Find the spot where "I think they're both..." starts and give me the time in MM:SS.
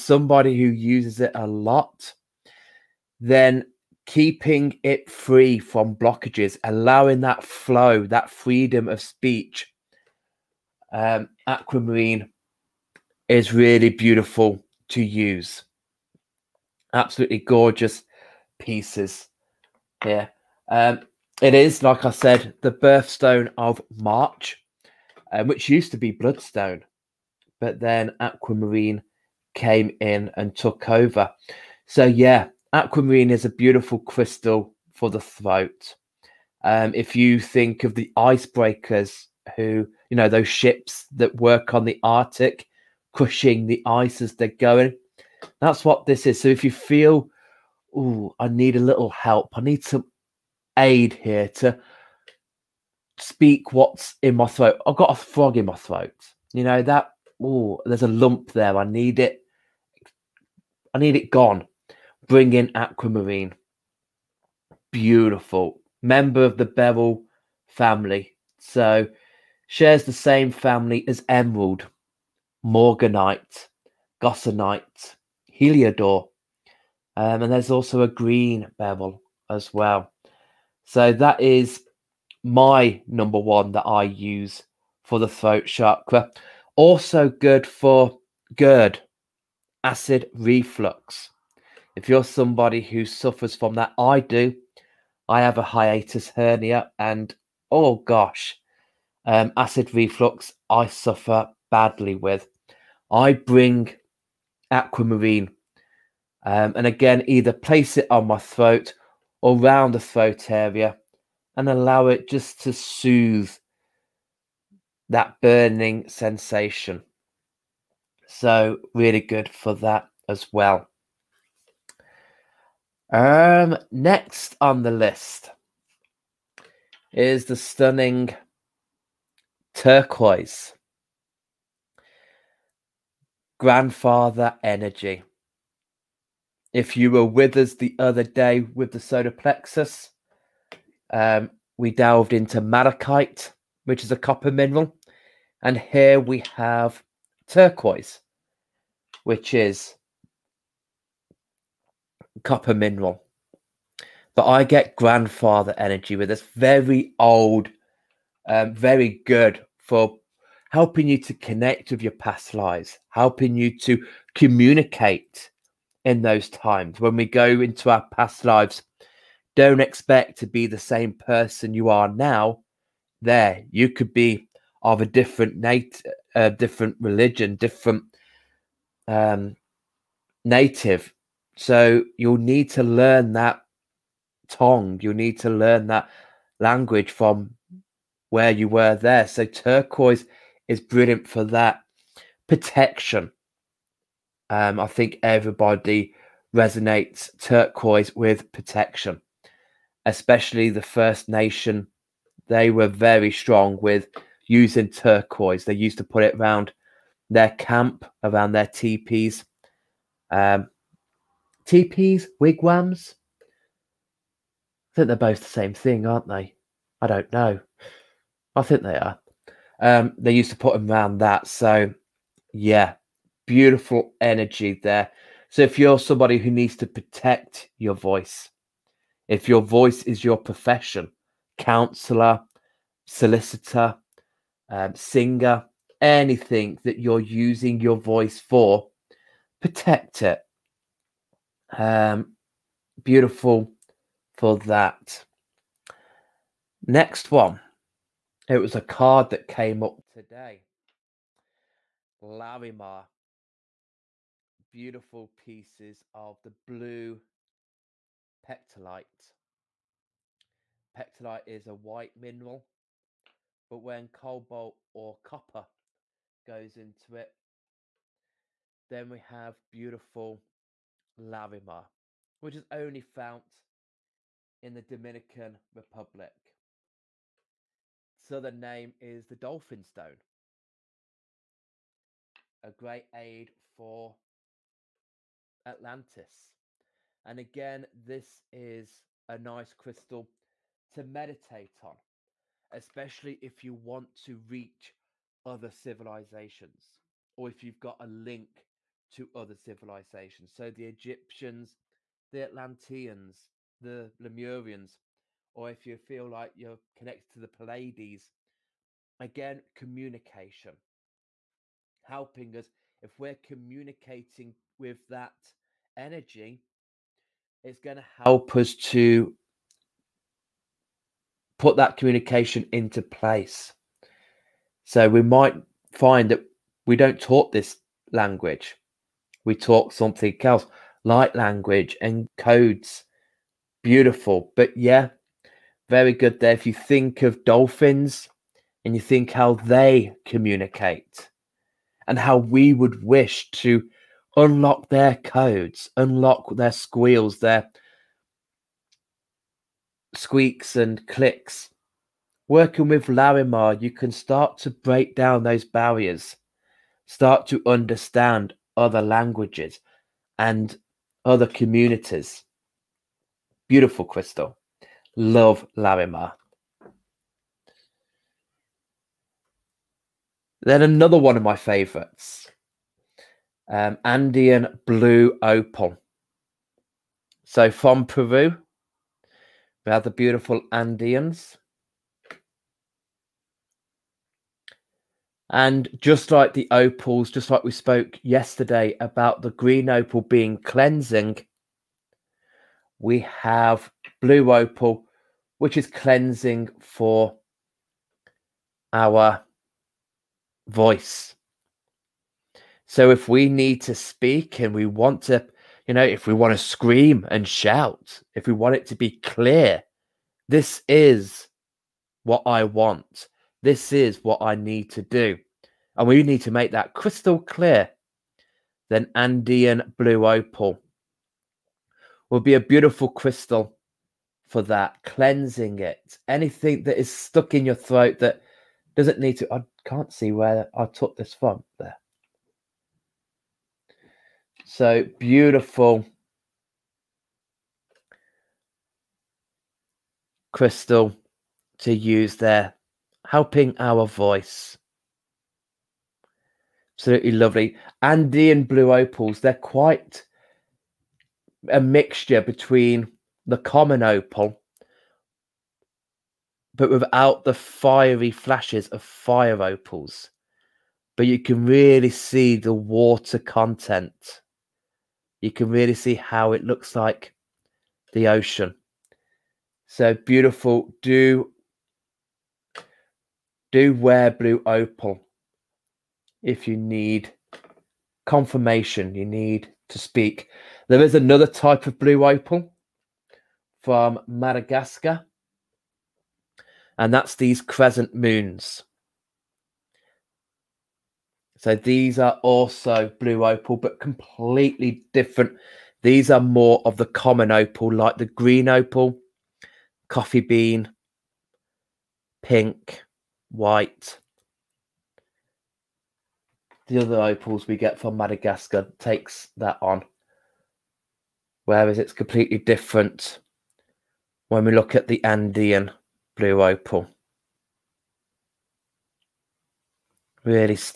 03:34.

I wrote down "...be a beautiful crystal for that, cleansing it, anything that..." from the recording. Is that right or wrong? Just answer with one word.
right.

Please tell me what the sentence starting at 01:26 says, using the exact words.
Also good for GERD, acid reflux.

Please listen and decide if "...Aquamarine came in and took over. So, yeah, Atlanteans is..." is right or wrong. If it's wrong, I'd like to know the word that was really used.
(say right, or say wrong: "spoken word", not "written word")
wrong: "Aquamarine", not "Atlanteans".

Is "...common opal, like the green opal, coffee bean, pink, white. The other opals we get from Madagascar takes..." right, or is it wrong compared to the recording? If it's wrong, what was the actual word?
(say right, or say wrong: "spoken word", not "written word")
right.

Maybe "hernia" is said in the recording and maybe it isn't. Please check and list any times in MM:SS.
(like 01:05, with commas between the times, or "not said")
01:36.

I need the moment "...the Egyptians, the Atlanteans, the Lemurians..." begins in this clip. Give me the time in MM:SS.
05:00.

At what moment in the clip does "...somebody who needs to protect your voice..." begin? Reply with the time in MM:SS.
03:45.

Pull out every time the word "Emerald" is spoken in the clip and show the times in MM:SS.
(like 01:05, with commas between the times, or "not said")
01:11.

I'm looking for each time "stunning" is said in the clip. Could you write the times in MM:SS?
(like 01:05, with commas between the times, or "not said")
02:07.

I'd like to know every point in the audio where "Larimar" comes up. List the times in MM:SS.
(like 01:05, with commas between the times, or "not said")
04:12, 04:31, 05:53, 06:05.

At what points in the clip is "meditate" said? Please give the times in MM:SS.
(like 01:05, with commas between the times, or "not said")
04:51.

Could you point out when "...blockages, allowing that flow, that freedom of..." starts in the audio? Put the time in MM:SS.
00:05.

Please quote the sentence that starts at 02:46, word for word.
When we go into our past lives, don't expect to be the same person you are now.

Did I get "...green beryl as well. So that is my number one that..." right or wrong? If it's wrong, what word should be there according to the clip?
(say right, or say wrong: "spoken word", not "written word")
right.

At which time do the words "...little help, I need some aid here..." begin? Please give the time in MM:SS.
00:48.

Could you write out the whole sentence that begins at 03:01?
So you'll need to learn that tongue.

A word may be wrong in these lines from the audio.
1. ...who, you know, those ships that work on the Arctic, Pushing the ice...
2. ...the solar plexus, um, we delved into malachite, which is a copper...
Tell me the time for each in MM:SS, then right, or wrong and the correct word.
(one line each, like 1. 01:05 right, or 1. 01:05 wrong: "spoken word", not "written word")
1. 00:39 right
2. 02:18 right.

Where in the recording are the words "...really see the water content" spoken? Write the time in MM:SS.
07:41.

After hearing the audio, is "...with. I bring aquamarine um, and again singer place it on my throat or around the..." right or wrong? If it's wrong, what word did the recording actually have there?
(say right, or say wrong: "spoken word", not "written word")
wrong: "either", not "singer".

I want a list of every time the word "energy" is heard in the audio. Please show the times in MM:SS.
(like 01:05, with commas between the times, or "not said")
02:14, 02:35, 03:44, 05:15.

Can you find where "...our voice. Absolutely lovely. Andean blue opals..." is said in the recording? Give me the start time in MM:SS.
07:23.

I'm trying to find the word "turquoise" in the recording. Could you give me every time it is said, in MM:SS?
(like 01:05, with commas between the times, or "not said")
02:09, 02:27, 03:09, 03:17, 03:24.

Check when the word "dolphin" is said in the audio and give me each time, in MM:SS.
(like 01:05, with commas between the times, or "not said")
04:39, 05:37.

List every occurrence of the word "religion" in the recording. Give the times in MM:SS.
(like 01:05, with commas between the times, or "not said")
02:56.